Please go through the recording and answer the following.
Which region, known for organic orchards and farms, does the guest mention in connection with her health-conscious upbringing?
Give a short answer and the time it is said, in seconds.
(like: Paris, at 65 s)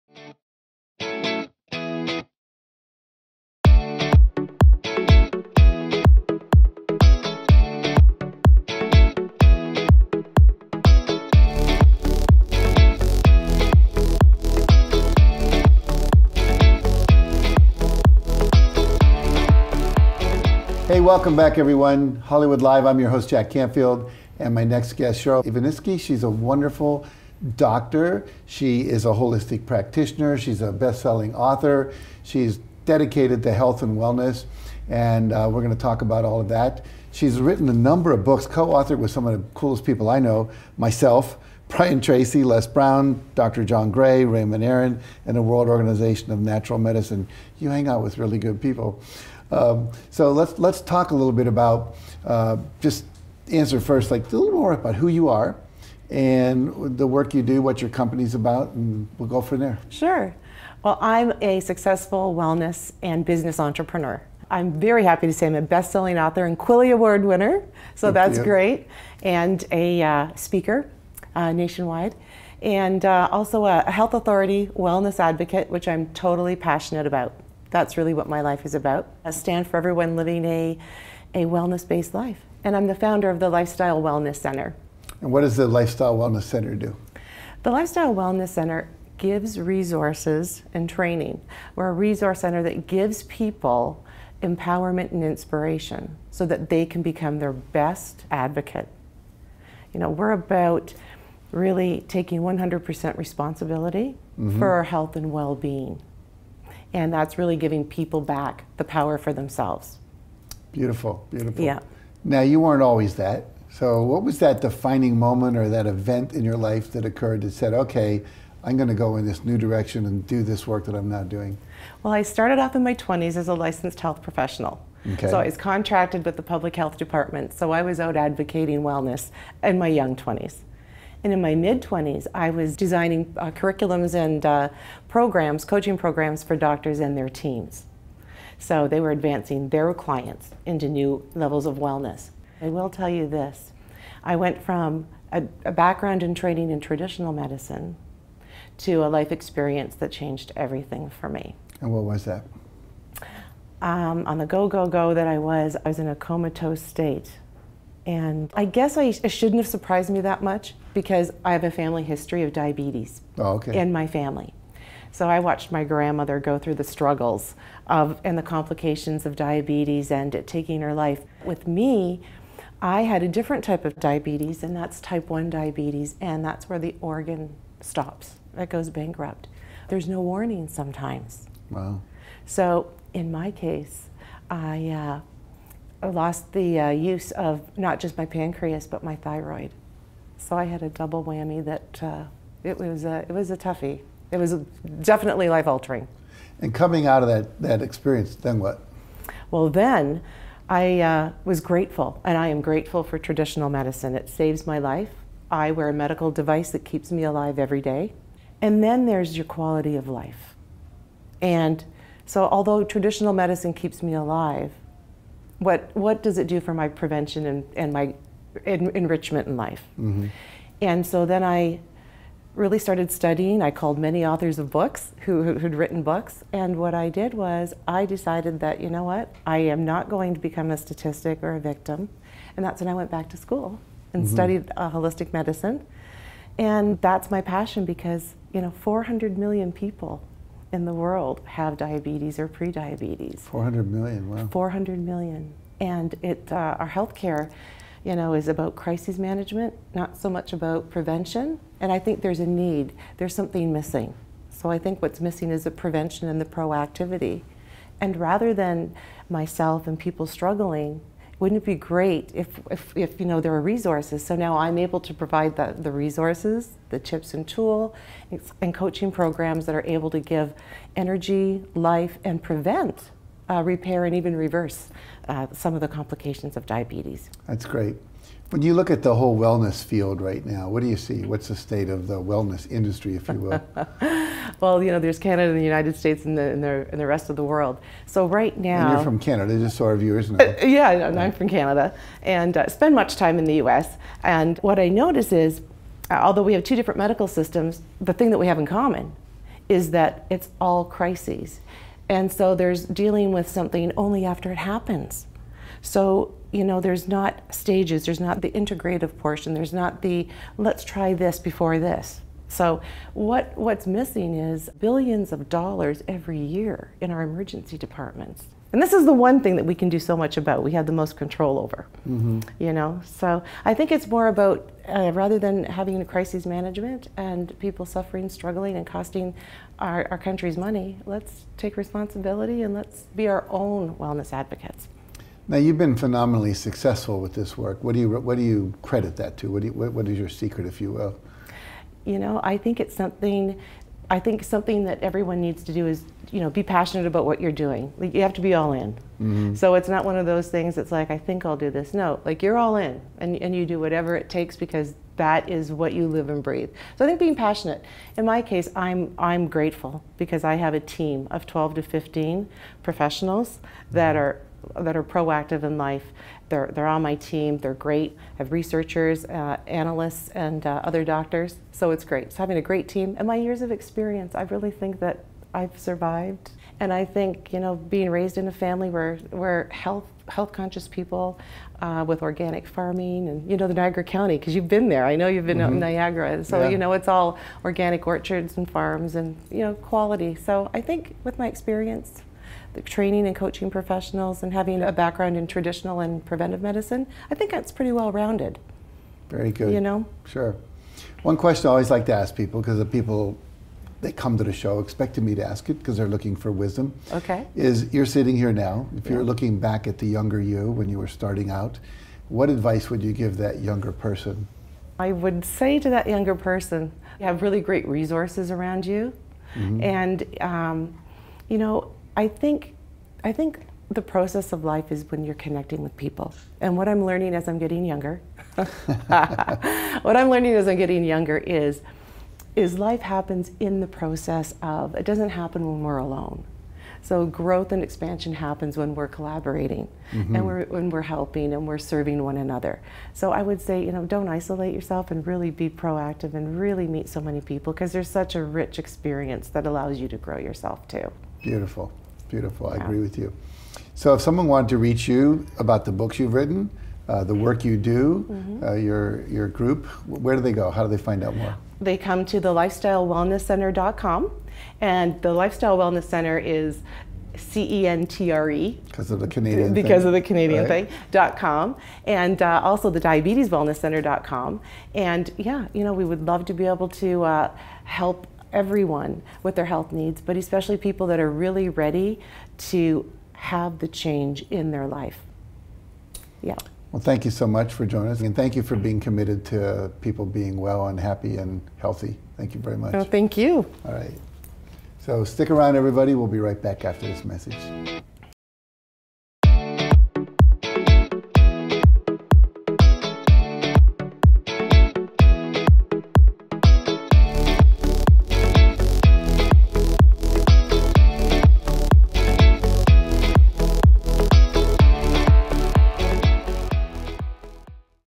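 Niagara County, at 383 s.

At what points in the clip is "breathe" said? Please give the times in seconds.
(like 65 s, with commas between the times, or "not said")
356 s.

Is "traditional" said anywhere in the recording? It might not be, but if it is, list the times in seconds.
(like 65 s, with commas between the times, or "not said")
146 s, 203 s, 212 s, 395 s.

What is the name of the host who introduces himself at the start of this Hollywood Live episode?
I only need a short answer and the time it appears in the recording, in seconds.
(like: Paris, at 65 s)
Jack Canfield, at 23 s.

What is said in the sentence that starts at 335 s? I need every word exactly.
Now you've been phenomenally successful with this work.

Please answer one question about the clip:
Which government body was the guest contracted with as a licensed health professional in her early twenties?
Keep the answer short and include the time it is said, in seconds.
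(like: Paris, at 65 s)
public health department, at 126 s.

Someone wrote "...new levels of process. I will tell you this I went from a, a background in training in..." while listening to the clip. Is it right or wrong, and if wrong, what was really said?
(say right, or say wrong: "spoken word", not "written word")
wrong: "wellness", not "process".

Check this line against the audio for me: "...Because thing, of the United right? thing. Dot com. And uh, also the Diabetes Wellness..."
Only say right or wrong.
wrong.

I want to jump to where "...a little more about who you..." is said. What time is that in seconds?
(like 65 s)
54 s.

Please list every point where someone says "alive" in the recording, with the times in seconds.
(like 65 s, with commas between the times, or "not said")
207 s, 214 s.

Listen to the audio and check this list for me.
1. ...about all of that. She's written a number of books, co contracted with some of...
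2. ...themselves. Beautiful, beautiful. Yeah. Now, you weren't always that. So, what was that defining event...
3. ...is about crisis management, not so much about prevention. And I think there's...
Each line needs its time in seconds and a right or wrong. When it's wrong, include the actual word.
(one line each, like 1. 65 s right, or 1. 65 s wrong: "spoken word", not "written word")
1. 36 s wrong: "authored", not "contracted"
2. 109 s wrong: "moment", not "event"
3. 248 s right.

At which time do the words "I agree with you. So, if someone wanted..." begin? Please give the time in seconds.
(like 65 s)
452 s.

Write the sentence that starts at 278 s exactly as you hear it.
When you look at the whole wellness field right now, what do you see?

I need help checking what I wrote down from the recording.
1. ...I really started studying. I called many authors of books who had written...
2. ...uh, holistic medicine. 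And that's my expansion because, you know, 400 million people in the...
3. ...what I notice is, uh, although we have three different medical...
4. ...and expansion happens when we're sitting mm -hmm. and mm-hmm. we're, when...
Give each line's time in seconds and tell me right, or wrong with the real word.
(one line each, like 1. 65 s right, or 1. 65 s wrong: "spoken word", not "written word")
1. 221 s right
2. 234 s wrong: "passion", not "expansion"
3. 294 s wrong: "two", not "three"
4. 437 s wrong: "collaborating", not "sitting".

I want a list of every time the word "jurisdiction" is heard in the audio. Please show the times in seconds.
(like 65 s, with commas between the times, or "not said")
not said.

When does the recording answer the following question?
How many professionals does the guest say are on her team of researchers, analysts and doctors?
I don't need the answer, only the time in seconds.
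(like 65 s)
361 s.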